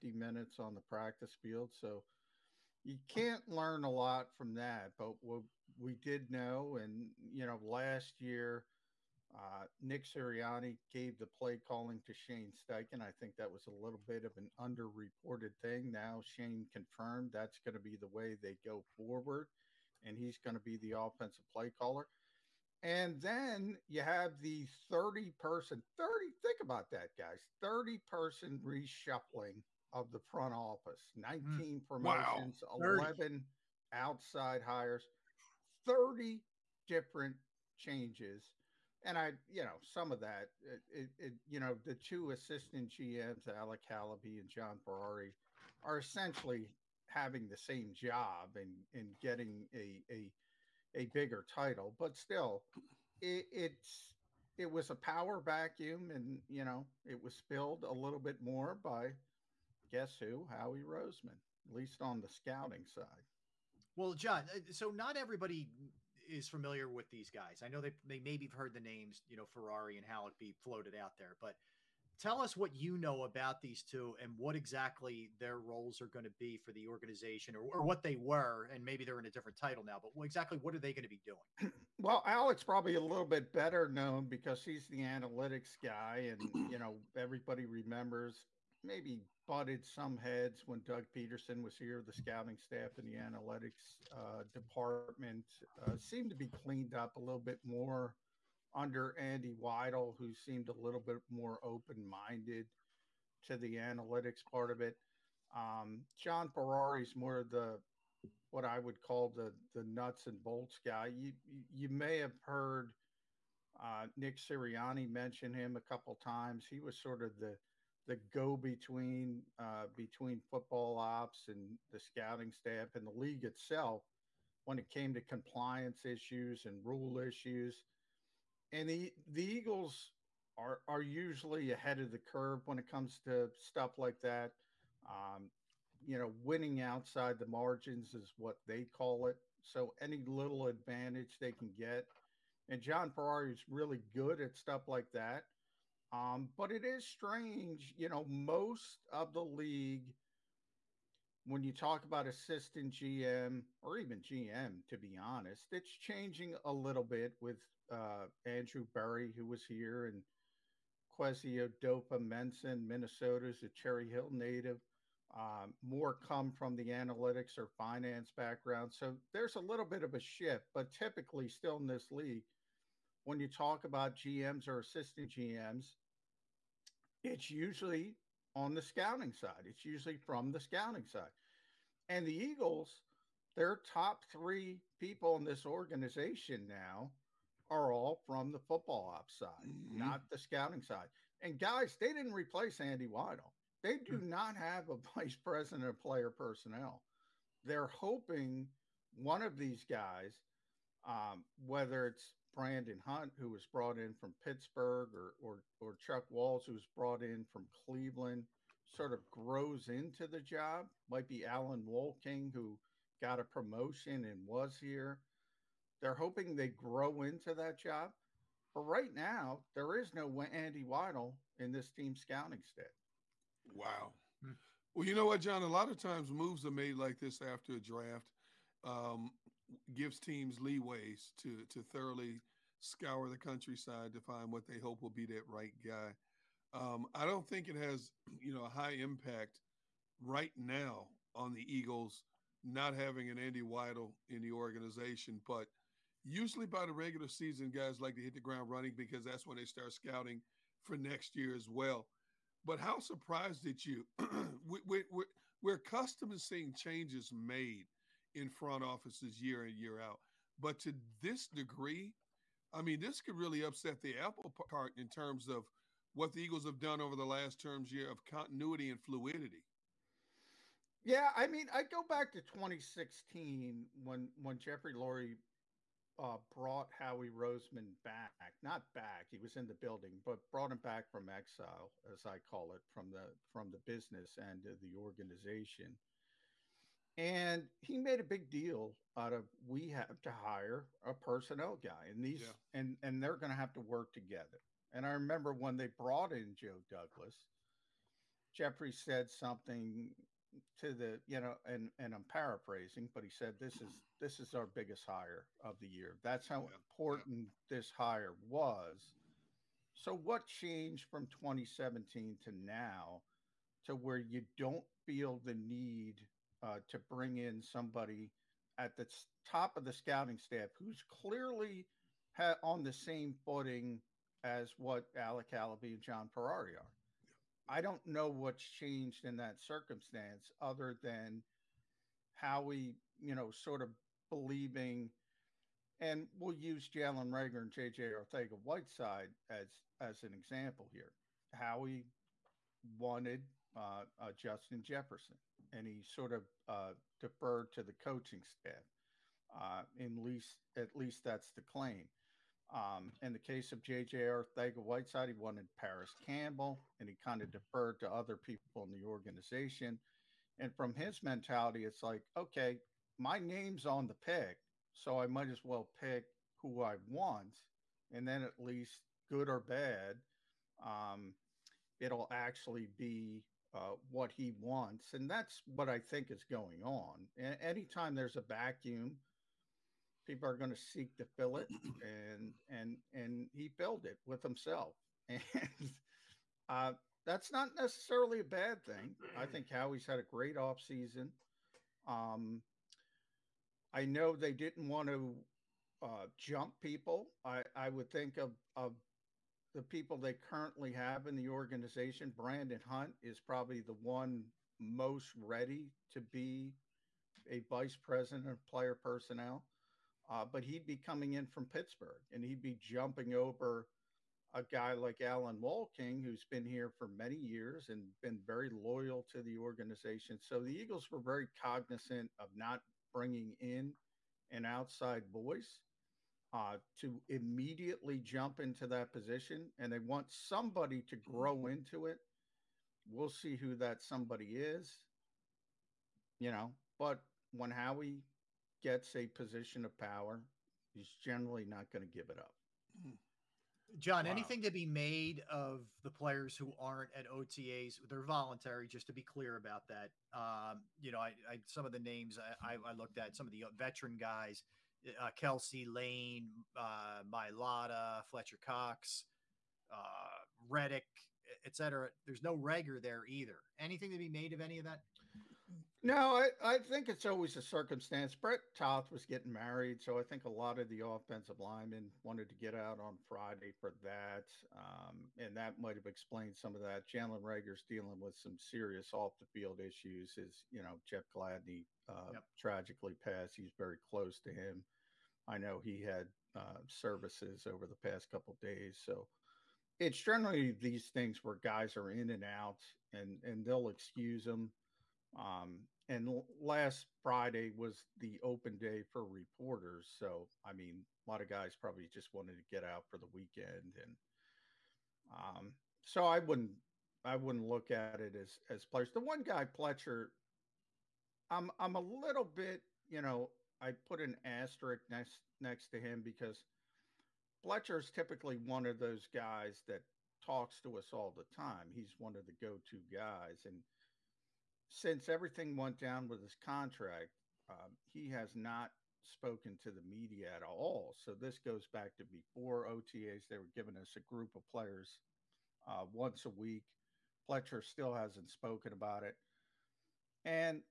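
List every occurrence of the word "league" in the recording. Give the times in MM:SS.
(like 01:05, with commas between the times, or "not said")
02:03, 02:29, 02:52.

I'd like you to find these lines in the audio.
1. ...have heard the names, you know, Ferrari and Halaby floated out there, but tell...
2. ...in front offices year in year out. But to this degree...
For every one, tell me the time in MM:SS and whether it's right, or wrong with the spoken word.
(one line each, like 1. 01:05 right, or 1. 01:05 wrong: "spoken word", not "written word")
1. 01:08 right
2. 04:18 right.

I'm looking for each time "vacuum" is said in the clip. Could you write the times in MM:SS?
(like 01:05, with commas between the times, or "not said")
00:55, 06:18.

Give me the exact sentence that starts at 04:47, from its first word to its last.
And he made a big deal out of we have to hire a personnel guy, and these yeah.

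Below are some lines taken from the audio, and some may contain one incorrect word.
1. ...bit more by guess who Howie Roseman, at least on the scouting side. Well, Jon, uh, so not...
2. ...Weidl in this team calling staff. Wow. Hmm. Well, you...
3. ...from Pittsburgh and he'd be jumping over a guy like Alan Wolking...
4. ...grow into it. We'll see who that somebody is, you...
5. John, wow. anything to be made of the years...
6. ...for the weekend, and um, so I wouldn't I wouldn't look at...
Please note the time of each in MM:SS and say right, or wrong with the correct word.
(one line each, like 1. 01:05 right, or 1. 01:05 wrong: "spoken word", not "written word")
1. 00:58 wrong: "John", not "Jon"
2. 03:40 wrong: "scouting", not "calling"
3. 06:51 right
4. 07:11 right
5. 07:23 wrong: "players", not "years"
6. 08:23 right.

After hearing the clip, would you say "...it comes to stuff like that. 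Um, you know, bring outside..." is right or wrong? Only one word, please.
wrong.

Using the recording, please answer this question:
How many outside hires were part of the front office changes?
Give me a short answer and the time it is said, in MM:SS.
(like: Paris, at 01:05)
11, at 00:32.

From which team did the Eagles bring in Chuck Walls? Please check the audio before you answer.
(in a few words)
Cleveland.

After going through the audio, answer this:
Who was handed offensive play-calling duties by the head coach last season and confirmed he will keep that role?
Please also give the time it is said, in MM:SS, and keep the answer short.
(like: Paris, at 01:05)
Shane Steichen, at 00:12.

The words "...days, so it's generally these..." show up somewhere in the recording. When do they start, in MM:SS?
08:08.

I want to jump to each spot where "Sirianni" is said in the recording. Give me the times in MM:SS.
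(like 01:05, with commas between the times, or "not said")
00:10, 01:54.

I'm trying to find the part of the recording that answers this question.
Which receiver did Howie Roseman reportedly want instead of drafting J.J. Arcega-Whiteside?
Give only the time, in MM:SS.
05:55.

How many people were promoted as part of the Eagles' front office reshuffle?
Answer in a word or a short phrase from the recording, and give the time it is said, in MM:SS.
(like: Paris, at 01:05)
19, at 00:31.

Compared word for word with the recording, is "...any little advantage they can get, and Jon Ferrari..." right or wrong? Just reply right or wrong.
right.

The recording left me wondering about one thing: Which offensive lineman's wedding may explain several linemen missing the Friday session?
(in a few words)
Brett Toth.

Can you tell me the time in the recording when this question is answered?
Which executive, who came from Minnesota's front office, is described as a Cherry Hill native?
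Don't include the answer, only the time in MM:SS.
02:41.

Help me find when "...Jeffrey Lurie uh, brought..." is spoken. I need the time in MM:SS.
04:34.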